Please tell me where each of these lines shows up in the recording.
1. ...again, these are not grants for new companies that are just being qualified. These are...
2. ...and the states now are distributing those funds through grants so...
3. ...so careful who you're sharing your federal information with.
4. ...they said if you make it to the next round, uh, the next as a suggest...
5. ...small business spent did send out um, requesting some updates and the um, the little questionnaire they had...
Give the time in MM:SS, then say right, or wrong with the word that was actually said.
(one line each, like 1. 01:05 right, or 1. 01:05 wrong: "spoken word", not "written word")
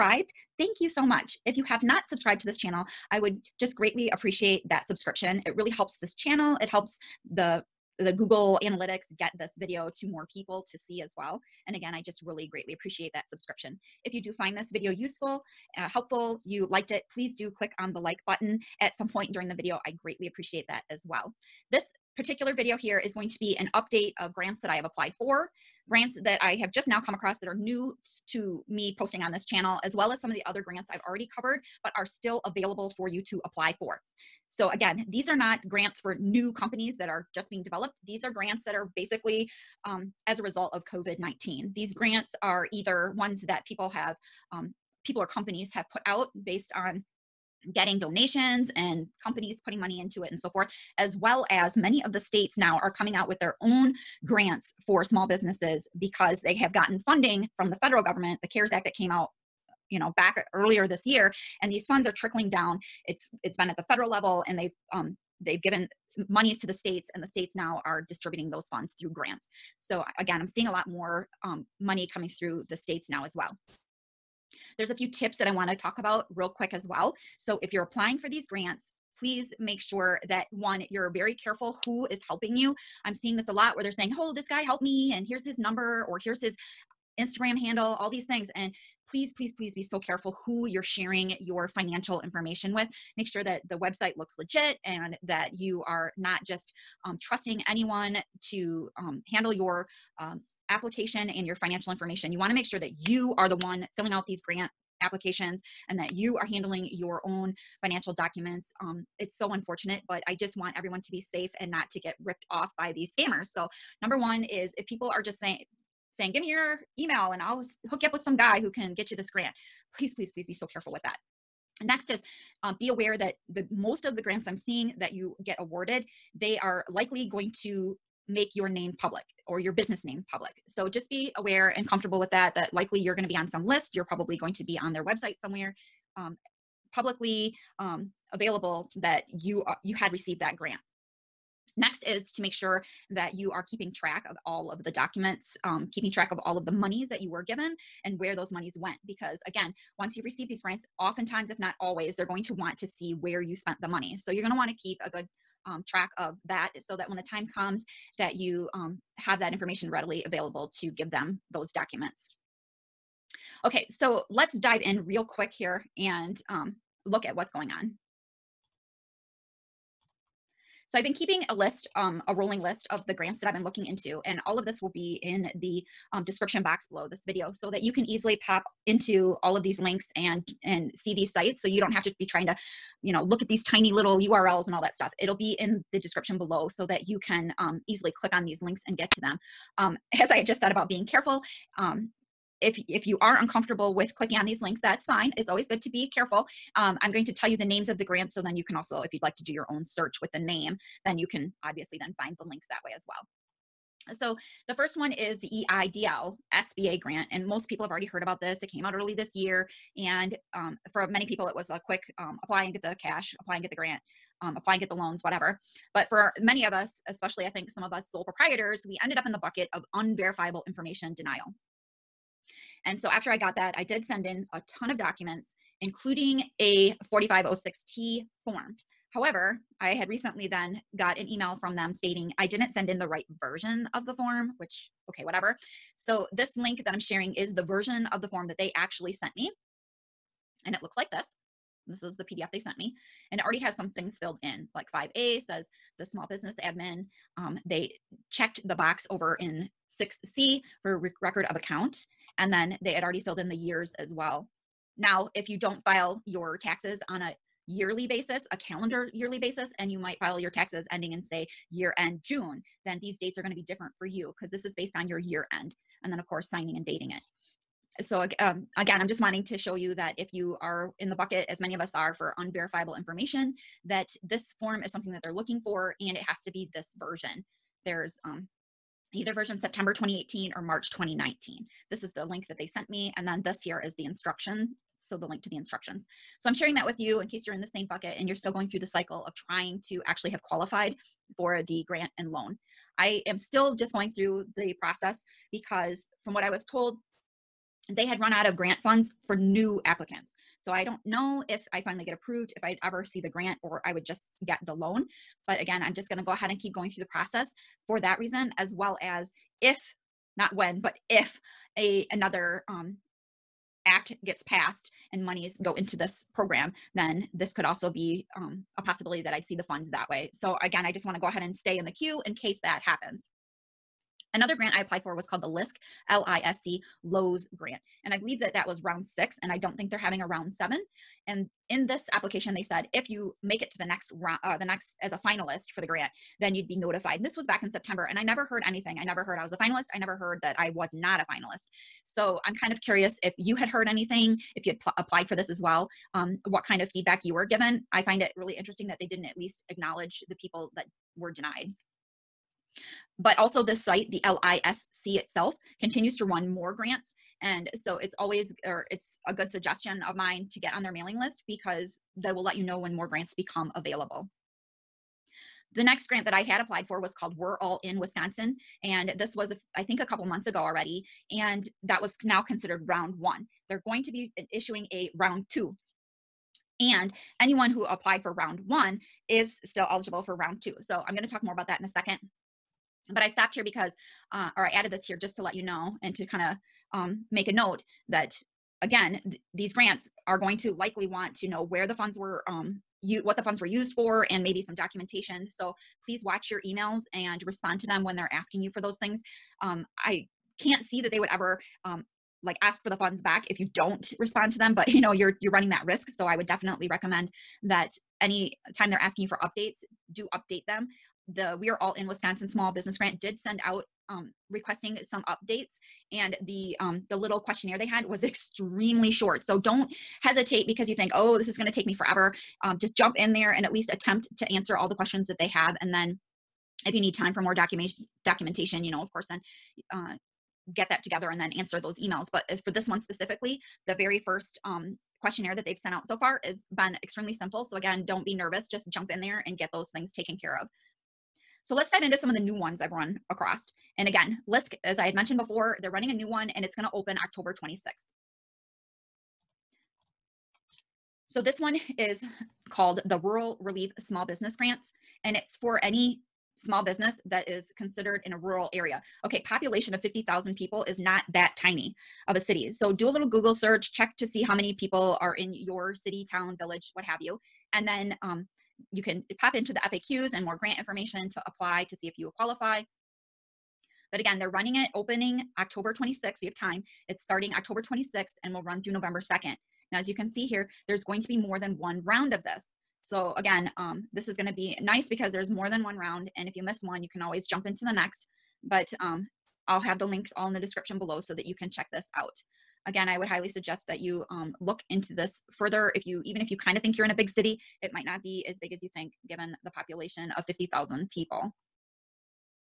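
1. 00:34 wrong: "developed", not "qualified"
2. 01:07 right
3. 01:29 wrong: "financial", not "federal"
4. 05:32 wrong: "finalist", not "suggest"
5. 06:52 wrong: "grant", not "spent".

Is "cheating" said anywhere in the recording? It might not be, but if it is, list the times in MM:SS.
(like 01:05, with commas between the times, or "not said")
not said.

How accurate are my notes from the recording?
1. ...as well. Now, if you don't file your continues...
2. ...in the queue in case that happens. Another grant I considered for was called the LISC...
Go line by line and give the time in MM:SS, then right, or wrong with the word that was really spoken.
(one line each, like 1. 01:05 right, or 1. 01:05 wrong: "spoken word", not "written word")
1. 04:13 wrong: "taxes", not "continues"
2. 05:21 wrong: "applied", not "considered".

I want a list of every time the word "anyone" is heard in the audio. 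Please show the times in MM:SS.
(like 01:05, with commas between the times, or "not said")
01:37, 06:17.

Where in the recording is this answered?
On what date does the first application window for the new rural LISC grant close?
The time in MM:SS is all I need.
07:58.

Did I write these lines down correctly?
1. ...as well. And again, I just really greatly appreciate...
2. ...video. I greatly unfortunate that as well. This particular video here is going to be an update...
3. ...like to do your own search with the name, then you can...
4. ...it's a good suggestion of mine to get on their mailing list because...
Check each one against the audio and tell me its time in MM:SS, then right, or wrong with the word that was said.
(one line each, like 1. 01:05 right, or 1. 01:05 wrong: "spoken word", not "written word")
1. 00:11 right
2. 00:19 wrong: "appreciate", not "unfortunate"
3. 03:19 right
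4. 05:58 right.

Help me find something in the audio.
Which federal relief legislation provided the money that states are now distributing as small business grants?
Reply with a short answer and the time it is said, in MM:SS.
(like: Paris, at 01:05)
CARES Act, at 00:58.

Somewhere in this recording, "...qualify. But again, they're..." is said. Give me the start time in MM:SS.
07:52.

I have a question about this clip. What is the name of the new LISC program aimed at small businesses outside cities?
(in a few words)
Rural Relief Small Business Grants.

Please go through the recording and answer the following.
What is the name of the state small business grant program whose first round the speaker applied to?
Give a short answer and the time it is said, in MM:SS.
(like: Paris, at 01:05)
We're All in Wisconsin, at 06:07.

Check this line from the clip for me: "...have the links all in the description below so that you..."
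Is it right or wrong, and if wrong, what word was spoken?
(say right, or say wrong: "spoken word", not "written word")
right.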